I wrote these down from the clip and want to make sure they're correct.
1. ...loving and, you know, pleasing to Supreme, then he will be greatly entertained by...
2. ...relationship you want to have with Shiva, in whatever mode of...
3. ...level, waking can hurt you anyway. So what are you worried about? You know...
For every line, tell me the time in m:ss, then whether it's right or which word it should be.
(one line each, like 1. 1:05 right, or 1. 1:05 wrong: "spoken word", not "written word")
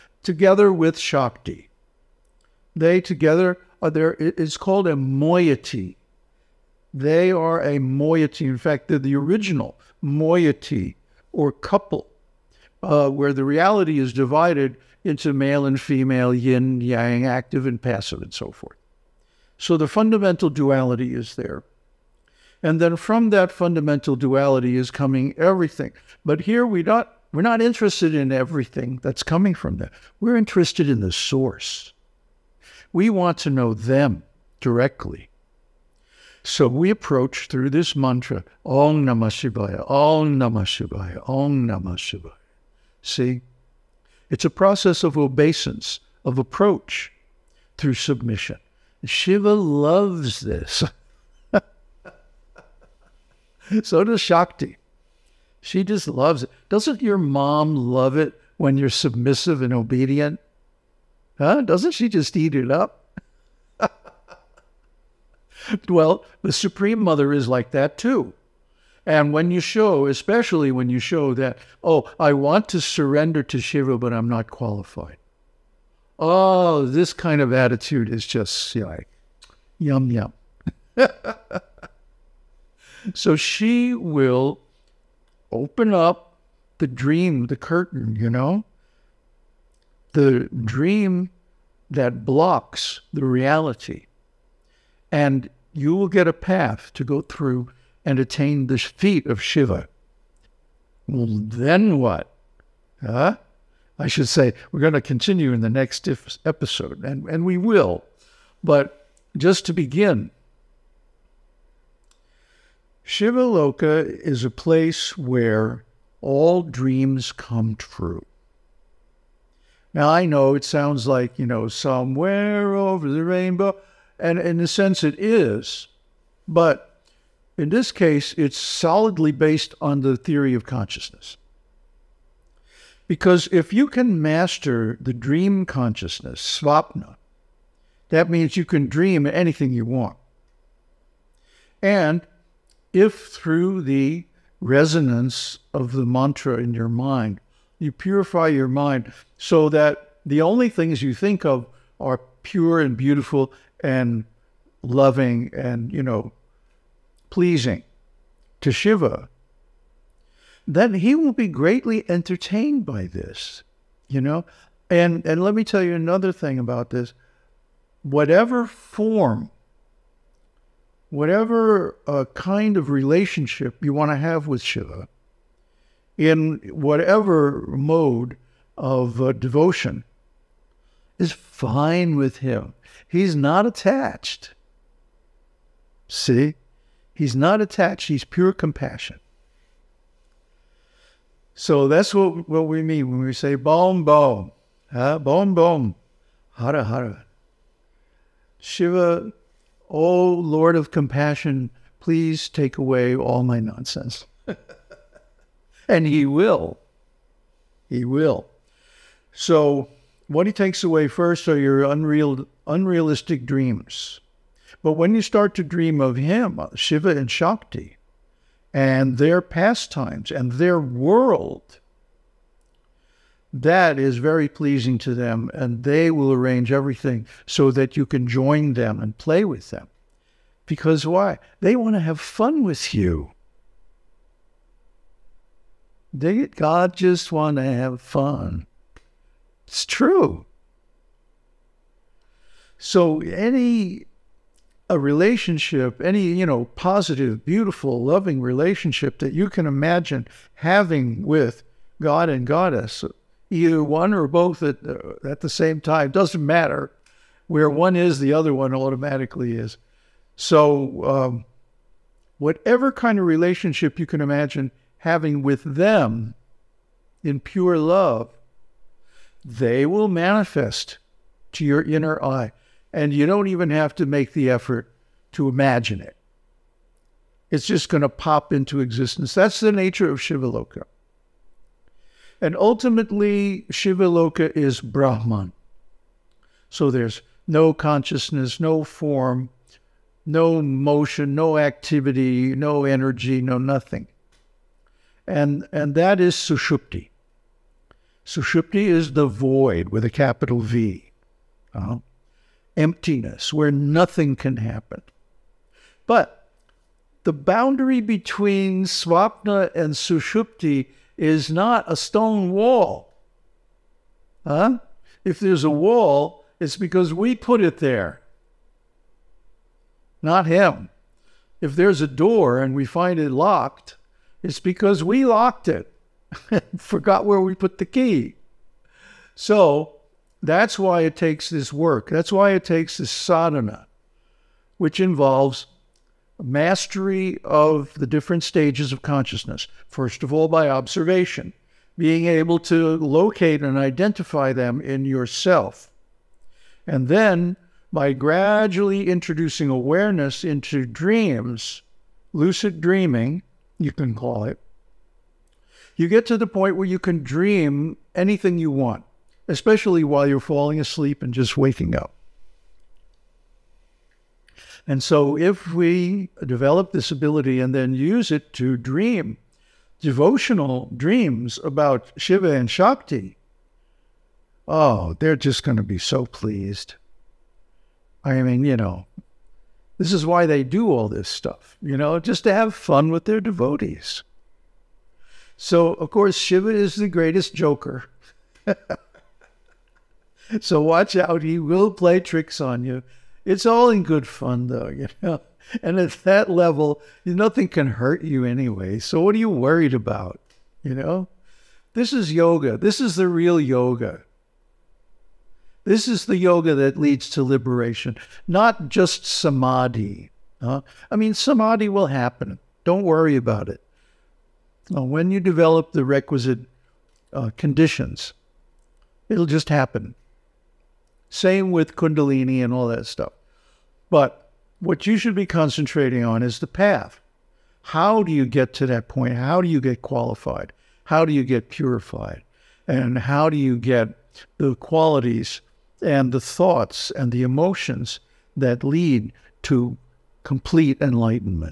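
1. 2:34 wrong: "Shiva", not "Supreme"
2. 2:52 right
3. 6:36 wrong: "nothing", not "waking".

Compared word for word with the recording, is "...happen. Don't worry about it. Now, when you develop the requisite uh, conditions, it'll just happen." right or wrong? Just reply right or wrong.
right.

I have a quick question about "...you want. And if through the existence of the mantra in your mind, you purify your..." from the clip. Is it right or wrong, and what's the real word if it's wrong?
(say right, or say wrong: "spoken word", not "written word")
wrong: "resonance", not "existence".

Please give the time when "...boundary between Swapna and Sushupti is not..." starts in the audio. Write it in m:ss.
5:07.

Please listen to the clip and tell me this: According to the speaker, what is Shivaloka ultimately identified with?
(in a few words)
Brahman.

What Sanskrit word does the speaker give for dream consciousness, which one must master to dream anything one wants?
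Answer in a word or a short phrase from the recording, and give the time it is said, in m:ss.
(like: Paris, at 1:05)
svapna, at 2:16.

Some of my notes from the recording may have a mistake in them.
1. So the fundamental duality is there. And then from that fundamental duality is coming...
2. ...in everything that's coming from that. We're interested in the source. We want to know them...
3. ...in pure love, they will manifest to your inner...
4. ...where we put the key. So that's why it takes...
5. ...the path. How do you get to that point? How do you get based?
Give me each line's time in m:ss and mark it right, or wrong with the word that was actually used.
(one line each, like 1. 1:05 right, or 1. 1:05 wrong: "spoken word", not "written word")
1. 0:19 right
2. 0:28 right
3. 4:27 right
4. 5:27 right
5. 7:06 wrong: "qualified", not "based".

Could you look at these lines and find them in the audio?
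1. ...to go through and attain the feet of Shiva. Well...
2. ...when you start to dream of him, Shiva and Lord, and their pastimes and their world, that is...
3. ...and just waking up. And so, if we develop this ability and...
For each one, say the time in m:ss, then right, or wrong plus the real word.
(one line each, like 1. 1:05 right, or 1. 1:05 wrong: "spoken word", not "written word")
1. 1:36 right
2. 3:34 wrong: "Shakti", not "Lord"
3. 6:01 right.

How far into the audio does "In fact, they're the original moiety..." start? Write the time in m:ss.
0:08.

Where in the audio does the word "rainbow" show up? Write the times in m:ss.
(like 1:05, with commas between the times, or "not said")
2:03.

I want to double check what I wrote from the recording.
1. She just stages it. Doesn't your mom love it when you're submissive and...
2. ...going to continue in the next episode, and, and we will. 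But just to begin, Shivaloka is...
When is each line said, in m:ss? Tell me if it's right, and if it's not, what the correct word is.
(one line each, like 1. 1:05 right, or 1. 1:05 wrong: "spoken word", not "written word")
1. 0:55 wrong: "loves", not "stages"
2. 1:44 right.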